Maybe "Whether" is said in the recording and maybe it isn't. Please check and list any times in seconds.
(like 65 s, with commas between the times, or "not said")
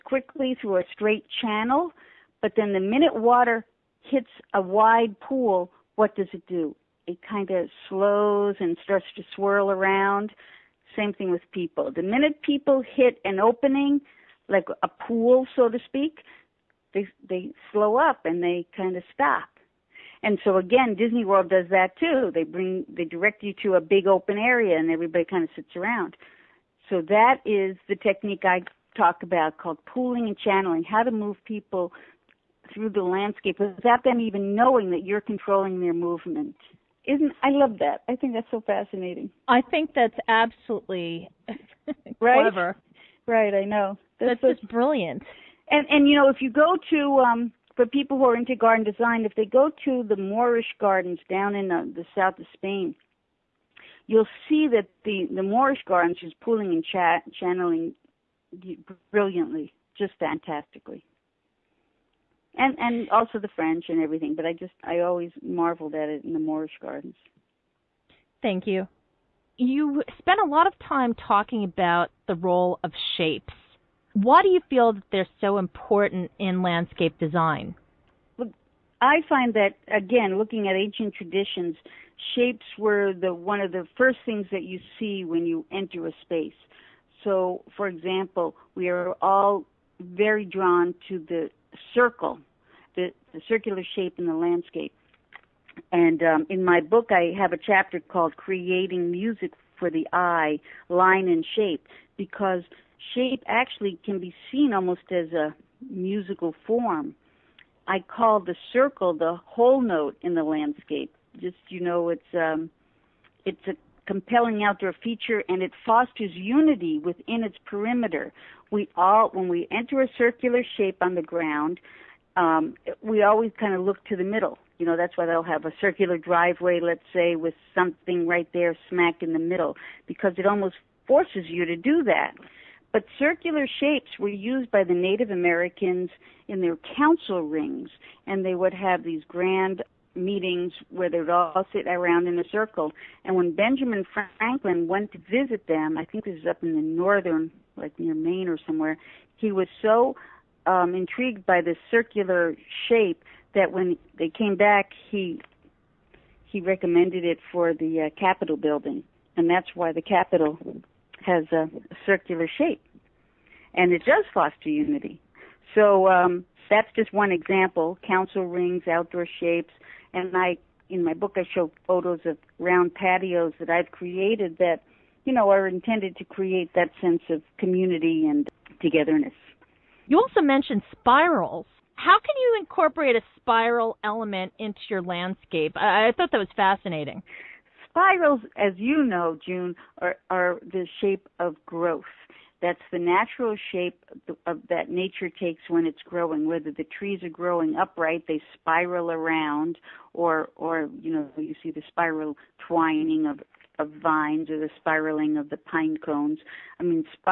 196 s.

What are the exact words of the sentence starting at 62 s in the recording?
And and also the French and everything, but I just I always marveled at it in the Moorish gardens.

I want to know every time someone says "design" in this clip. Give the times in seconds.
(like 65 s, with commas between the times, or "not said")
48 s, 77 s.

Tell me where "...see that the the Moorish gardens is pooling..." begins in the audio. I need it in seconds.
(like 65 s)
54 s.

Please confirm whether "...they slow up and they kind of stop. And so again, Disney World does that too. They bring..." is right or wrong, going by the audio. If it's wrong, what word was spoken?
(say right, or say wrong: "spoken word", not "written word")
right.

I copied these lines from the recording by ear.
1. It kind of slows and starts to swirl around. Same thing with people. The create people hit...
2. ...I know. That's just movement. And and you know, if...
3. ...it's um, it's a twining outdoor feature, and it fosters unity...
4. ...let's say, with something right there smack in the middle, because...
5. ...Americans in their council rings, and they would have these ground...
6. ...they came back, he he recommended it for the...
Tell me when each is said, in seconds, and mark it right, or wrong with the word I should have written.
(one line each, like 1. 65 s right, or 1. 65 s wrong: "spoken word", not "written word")
1. 7 s wrong: "minute", not "create"
2. 43 s wrong: "brilliant", not "movement"
3. 112 s wrong: "compelling", not "twining"
4. 126 s right
5. 135 s wrong: "grand", not "ground"
6. 154 s right.